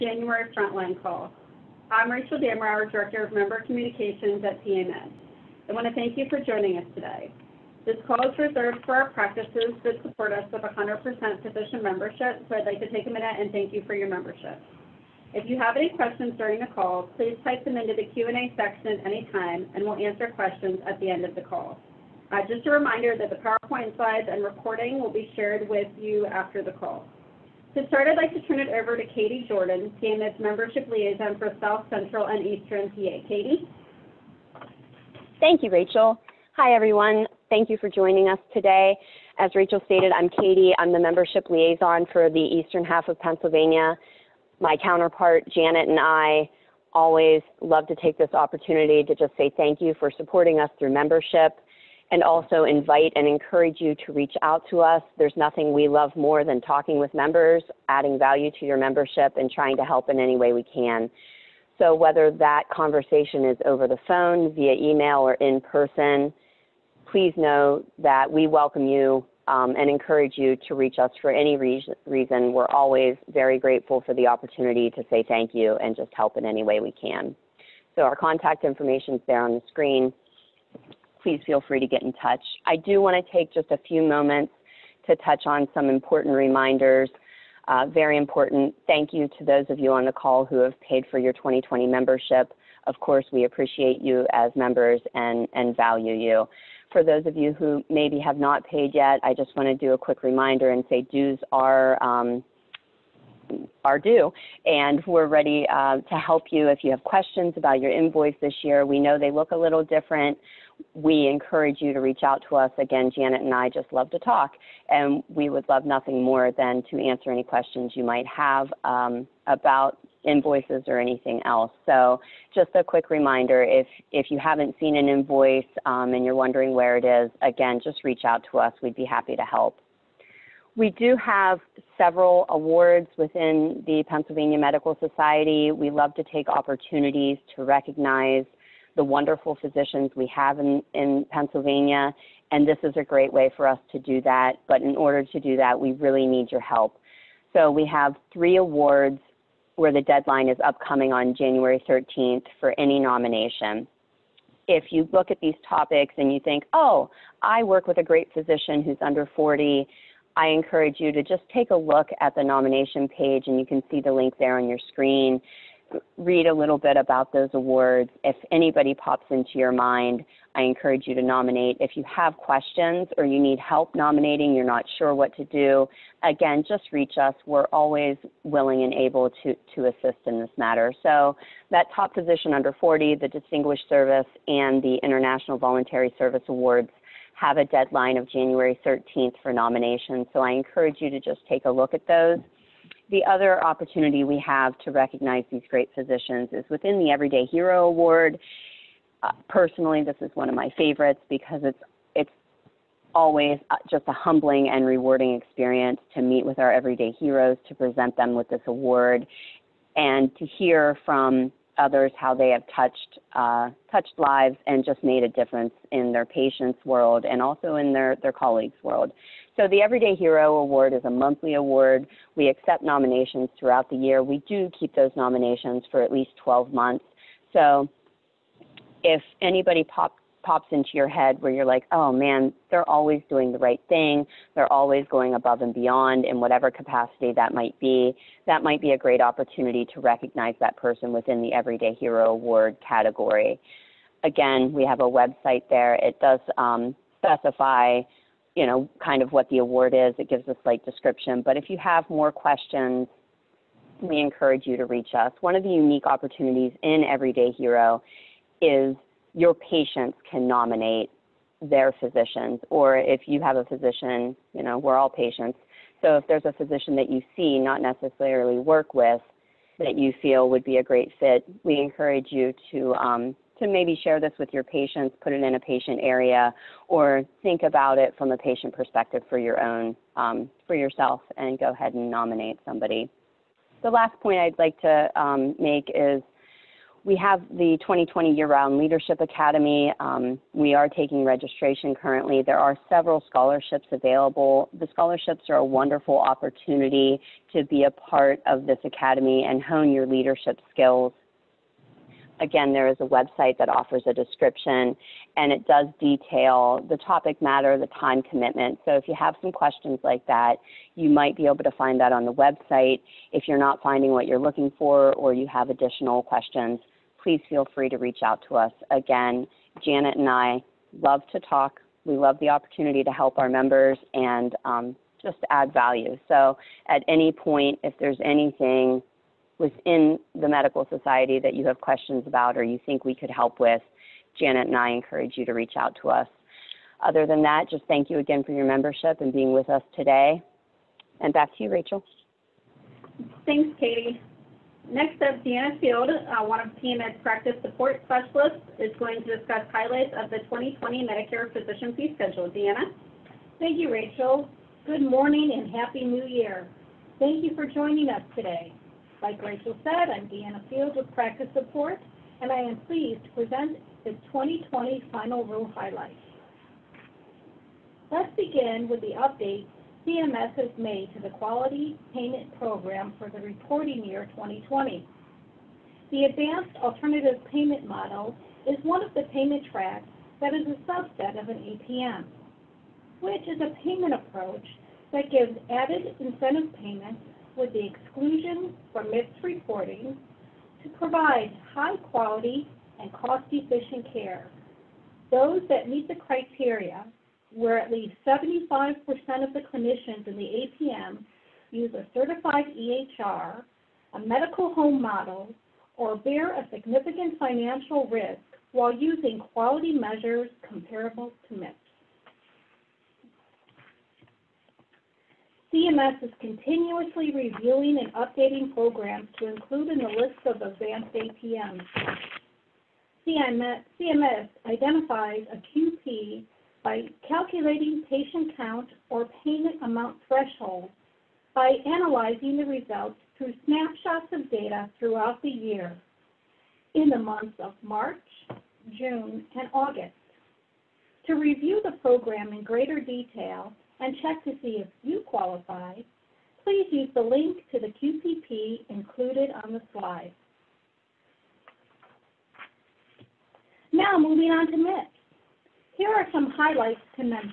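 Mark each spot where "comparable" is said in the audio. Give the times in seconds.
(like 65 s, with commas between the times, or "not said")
410 s.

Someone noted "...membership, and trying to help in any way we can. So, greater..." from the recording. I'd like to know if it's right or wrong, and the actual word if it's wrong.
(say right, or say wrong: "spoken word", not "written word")
wrong: "whether", not "greater".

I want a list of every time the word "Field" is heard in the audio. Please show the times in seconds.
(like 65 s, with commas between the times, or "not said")
345 s, 360 s.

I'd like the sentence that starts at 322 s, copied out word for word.
We love the opportunity to help our members and um, just add value.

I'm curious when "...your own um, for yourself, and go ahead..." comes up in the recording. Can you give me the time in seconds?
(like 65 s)
279 s.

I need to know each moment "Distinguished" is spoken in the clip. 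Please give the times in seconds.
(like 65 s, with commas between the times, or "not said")
183 s.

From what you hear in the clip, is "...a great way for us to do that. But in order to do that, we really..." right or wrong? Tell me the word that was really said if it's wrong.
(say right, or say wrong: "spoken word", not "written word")
right.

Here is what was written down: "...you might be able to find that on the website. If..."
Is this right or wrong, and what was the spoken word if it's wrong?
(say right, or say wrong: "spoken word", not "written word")
right.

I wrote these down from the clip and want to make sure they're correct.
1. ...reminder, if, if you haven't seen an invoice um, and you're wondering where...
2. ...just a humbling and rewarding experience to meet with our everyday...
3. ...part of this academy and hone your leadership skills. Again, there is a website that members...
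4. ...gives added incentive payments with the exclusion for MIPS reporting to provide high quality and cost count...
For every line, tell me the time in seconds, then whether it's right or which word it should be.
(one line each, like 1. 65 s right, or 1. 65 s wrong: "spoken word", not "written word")
1. 123 s right
2. 203 s right
3. 297 s wrong: "offers", not "members"
4. 385 s wrong: "efficient", not "count".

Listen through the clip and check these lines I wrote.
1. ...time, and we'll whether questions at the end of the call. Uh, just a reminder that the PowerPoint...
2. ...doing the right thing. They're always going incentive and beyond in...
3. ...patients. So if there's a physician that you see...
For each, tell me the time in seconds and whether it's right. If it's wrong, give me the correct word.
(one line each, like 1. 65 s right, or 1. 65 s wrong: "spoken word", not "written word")
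1. 19 s wrong: "answer", not "whether"
2. 233 s wrong: "above", not "incentive"
3. 265 s right.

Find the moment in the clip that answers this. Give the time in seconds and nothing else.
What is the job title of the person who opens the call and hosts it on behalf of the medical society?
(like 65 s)
2 s.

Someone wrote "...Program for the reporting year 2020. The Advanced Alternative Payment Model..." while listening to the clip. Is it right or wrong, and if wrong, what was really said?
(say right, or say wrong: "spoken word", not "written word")
right.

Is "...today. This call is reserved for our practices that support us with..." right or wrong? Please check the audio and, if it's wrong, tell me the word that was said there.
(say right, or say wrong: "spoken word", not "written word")
right.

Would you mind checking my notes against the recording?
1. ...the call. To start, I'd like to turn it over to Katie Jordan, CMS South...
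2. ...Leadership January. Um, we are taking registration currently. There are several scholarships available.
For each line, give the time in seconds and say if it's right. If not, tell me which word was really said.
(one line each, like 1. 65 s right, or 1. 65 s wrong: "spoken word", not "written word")
1. 26 s wrong: "Membership", not "South"
2. 288 s wrong: "Academy", not "January".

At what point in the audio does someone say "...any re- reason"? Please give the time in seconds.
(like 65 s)
71 s.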